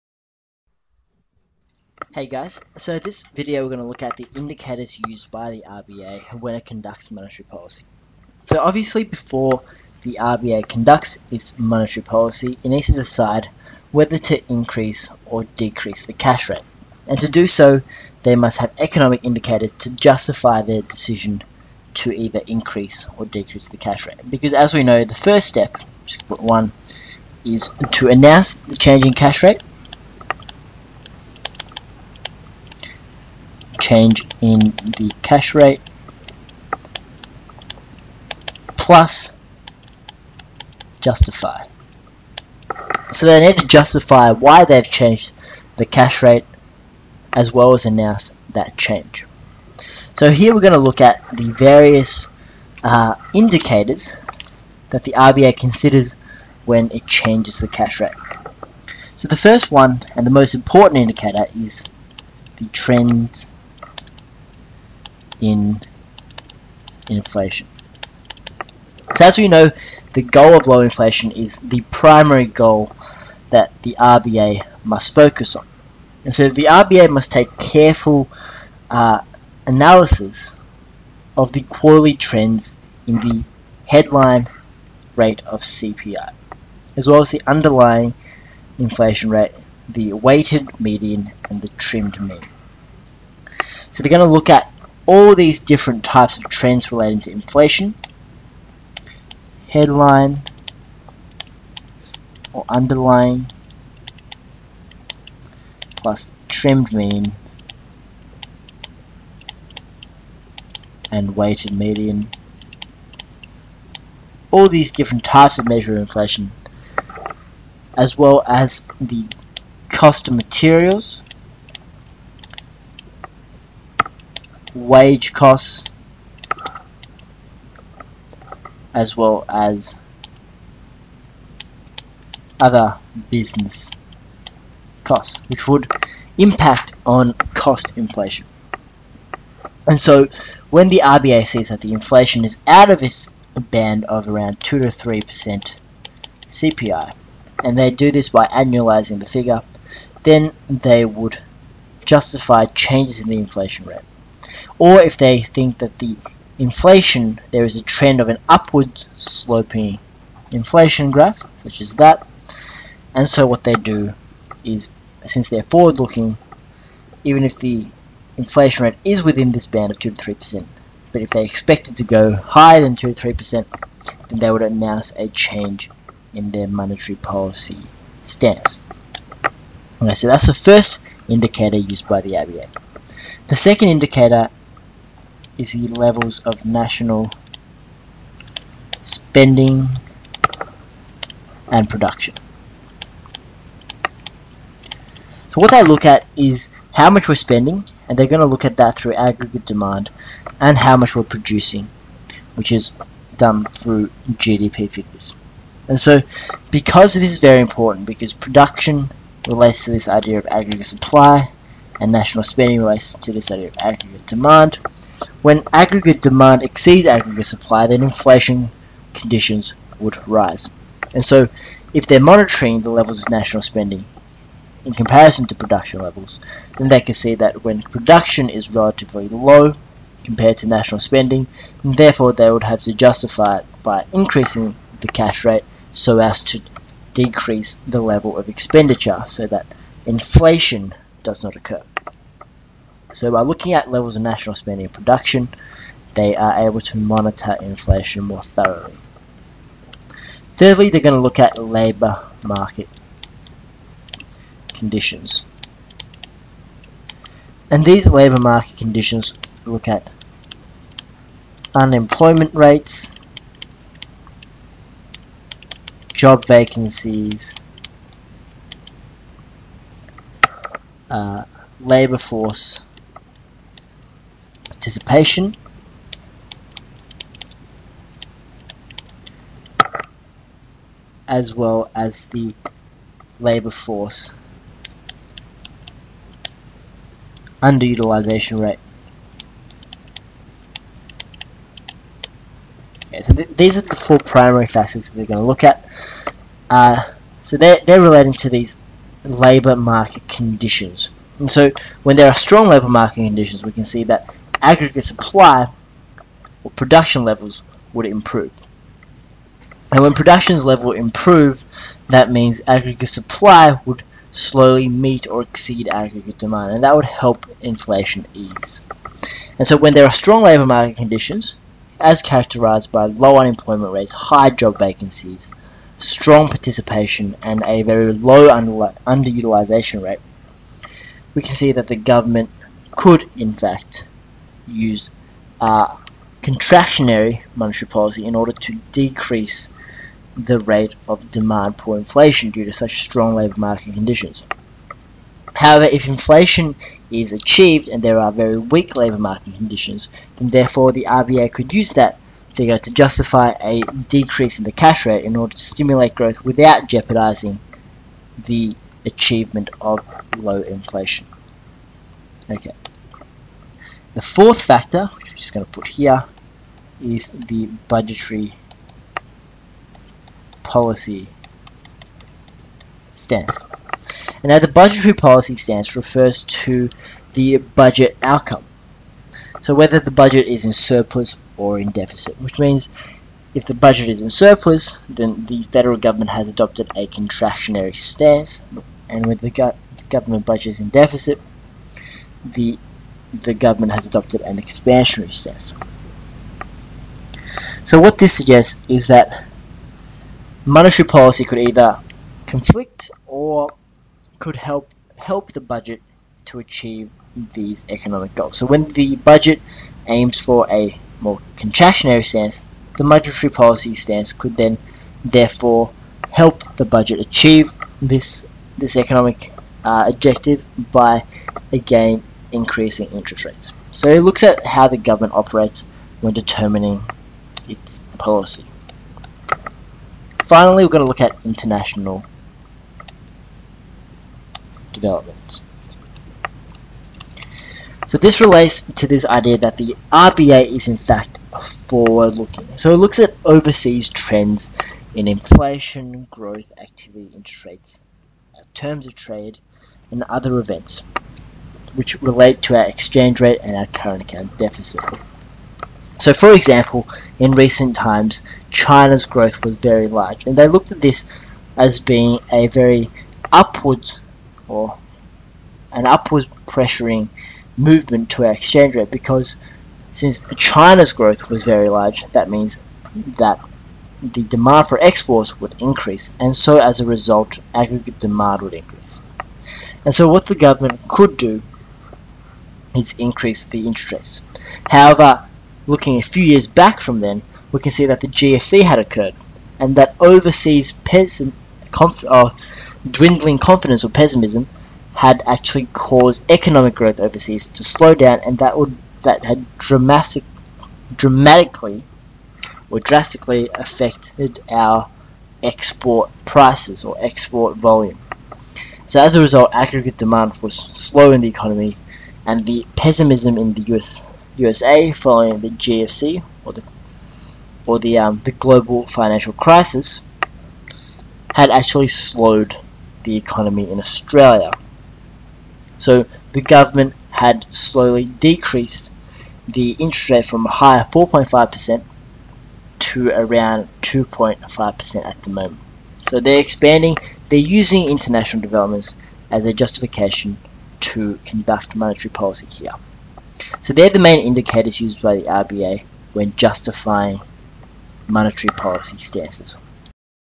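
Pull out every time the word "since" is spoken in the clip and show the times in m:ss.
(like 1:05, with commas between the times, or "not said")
2:45, 7:50.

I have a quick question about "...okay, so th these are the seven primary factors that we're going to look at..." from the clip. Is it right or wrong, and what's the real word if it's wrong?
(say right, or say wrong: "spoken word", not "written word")
wrong: "four", not "seven".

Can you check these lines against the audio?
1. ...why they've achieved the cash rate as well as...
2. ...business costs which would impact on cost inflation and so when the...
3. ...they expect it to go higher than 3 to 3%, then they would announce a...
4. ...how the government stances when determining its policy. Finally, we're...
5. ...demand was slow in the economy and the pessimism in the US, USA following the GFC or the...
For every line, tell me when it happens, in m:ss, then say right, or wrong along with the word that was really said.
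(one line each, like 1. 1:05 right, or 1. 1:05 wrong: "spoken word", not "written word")
1. 0:44 wrong: "changed", not "achieved"
2. 2:13 right
3. 2:51 wrong: "2", not "3"
4. 7:04 wrong: "operates", not "stances"
5. 8:30 right.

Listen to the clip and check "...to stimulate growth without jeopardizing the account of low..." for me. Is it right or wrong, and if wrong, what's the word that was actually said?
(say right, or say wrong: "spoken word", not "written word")
wrong: "achievement", not "account".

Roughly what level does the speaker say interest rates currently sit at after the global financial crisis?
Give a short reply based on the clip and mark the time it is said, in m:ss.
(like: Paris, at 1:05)
2.5%, at 8:54.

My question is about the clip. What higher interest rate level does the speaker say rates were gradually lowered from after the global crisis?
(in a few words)
4.5%.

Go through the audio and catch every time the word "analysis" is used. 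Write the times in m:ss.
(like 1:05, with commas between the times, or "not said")
1:19.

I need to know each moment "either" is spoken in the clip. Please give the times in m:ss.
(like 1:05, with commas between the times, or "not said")
0:22, 6:41.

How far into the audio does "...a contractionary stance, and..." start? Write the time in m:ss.
6:26.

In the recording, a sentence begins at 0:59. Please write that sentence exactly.
So the first one and the most important indicator is the trend in inflation.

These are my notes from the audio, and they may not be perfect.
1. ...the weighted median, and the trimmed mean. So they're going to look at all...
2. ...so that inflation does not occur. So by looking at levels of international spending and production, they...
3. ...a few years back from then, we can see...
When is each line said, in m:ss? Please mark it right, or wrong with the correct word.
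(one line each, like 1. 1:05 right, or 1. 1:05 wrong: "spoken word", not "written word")
1. 1:29 right
2. 3:59 wrong: "national", not "international"
3. 8:06 right.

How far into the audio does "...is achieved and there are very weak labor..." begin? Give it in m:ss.
5:47.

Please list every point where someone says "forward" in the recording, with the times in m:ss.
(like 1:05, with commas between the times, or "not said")
2:45, 7:21.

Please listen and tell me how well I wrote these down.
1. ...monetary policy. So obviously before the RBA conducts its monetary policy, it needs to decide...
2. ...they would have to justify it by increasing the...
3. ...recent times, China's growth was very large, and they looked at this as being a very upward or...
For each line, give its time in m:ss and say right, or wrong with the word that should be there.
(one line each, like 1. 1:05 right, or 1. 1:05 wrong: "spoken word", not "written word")
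1. 0:07 right
2. 3:52 right
3. 7:37 right.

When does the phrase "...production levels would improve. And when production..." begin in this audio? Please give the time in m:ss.
5:06.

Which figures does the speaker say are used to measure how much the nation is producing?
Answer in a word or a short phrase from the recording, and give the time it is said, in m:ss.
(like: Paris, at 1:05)
GDP figures, at 3:24.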